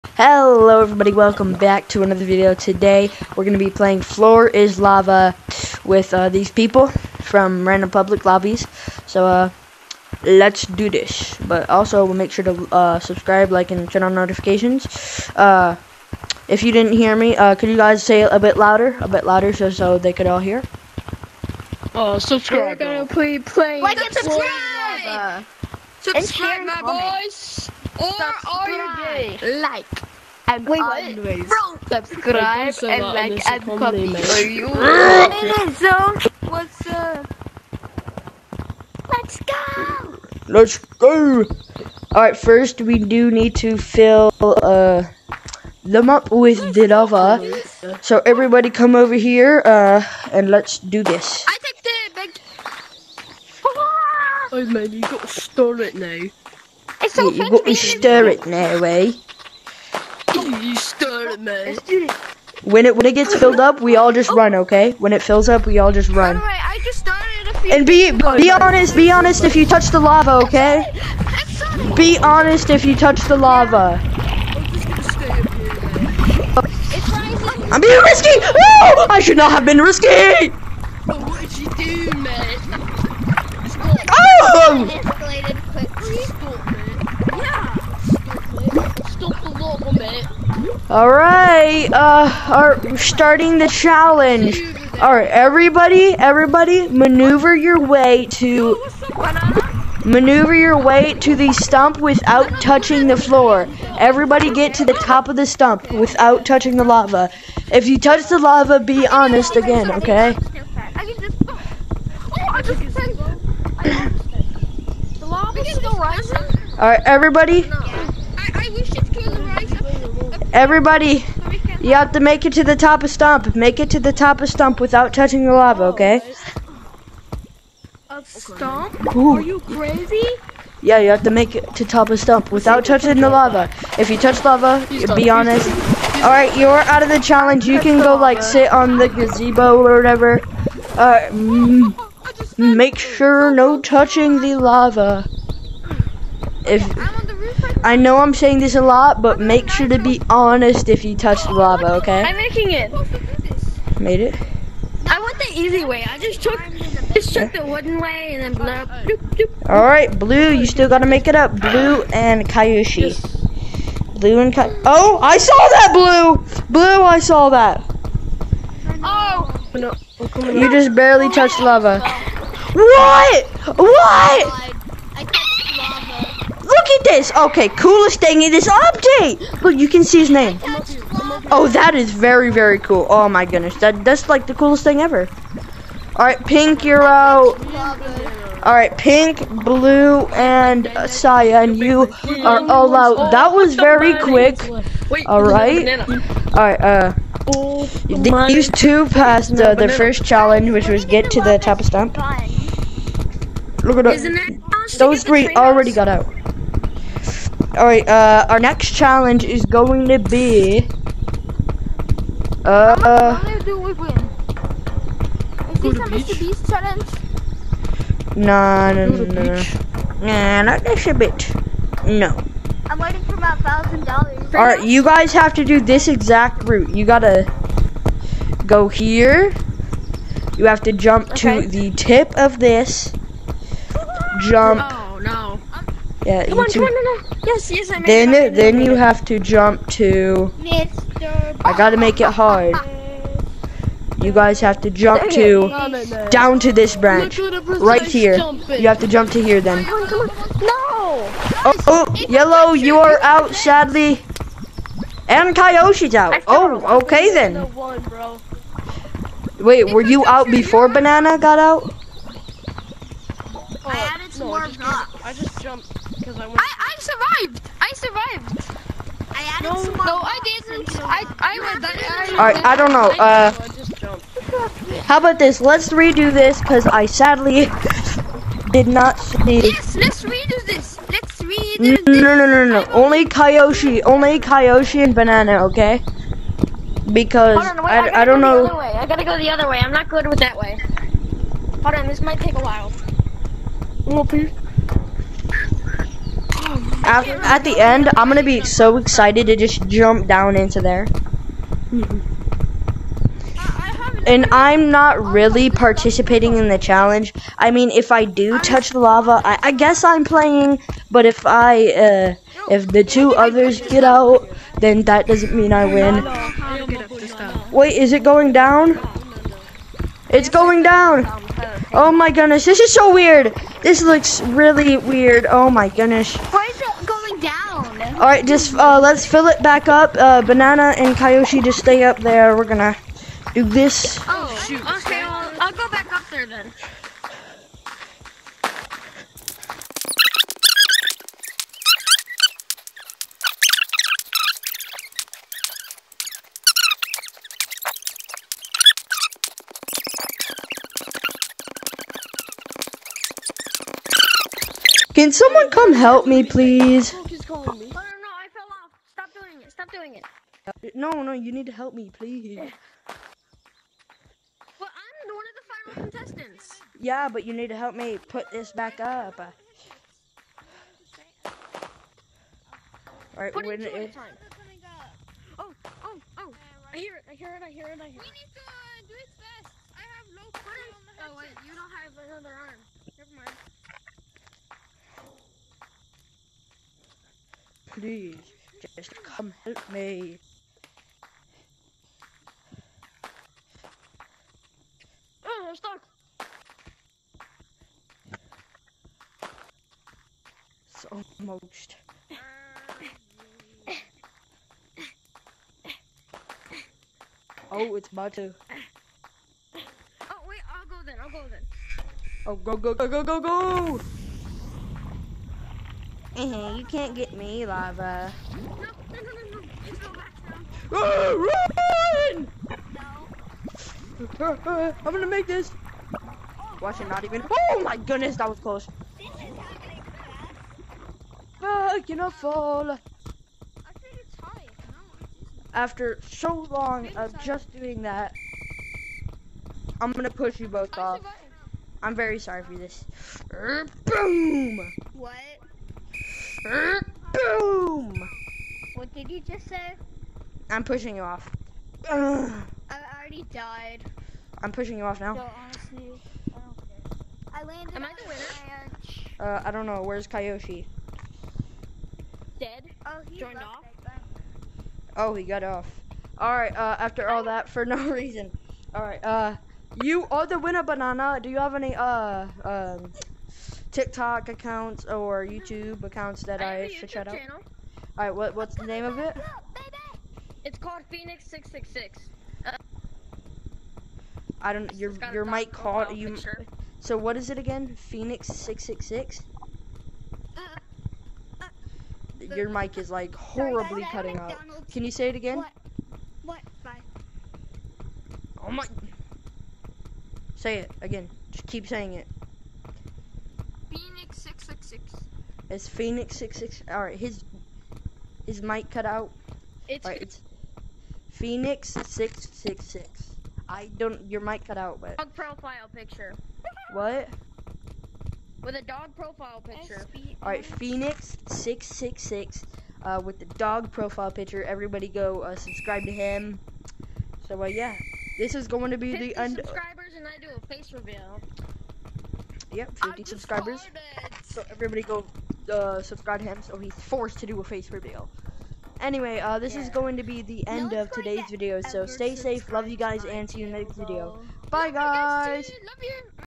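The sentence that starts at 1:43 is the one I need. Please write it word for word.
Everybody, get to the top of the stump without touching the lava.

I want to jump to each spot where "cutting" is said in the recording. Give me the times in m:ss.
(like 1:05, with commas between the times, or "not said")
8:14.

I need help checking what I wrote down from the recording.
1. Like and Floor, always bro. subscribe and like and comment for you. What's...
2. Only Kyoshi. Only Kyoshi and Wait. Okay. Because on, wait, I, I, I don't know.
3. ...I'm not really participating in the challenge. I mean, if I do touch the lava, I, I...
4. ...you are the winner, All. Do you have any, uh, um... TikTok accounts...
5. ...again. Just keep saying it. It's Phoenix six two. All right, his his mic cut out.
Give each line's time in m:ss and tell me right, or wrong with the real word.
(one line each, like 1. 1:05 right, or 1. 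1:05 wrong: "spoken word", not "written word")
1. 0:29 wrong: "Wait", not "Floor"
2. 4:42 wrong: "Banana", not "Wait"
3. 5:04 right
4. 7:50 wrong: "Banana", not "All"
5. 8:21 wrong: "six", not "two".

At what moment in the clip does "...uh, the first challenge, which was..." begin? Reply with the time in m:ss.
3:19.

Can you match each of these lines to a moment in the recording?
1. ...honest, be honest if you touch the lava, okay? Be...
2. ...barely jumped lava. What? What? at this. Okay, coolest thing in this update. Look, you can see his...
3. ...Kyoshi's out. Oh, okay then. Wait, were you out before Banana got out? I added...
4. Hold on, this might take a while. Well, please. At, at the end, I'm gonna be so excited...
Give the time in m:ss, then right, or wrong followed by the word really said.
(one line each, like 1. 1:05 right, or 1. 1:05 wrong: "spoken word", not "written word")
1. 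1:08 right
2. 2:50 wrong: "touched", not "jumped"
3. 4:15 right
4. 4:51 right.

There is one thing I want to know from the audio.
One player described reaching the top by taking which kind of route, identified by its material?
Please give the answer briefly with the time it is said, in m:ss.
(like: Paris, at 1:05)
The wooden way, at 2:37.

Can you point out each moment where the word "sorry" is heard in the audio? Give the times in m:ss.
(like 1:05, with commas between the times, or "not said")
7:22, 8:14.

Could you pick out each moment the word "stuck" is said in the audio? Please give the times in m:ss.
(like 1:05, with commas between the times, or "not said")
6:35.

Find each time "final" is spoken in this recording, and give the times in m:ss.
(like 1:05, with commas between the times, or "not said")
6:05.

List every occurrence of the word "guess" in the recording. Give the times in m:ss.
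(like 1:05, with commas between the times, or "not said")
5:09.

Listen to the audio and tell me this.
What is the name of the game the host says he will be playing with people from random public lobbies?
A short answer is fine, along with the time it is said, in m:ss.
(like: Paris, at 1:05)
Floor is Lava, at 0:04.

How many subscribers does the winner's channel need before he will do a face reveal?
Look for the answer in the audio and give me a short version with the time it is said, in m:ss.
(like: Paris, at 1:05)
50, at 8:53.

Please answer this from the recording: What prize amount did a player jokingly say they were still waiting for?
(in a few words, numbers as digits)
1000 dollars.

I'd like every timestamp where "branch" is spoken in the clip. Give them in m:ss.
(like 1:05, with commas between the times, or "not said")
4:06.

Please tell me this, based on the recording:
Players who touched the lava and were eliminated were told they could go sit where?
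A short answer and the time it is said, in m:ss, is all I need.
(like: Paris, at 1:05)
The gazebo, at 2:19.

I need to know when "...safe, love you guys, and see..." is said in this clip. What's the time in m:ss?
9:02.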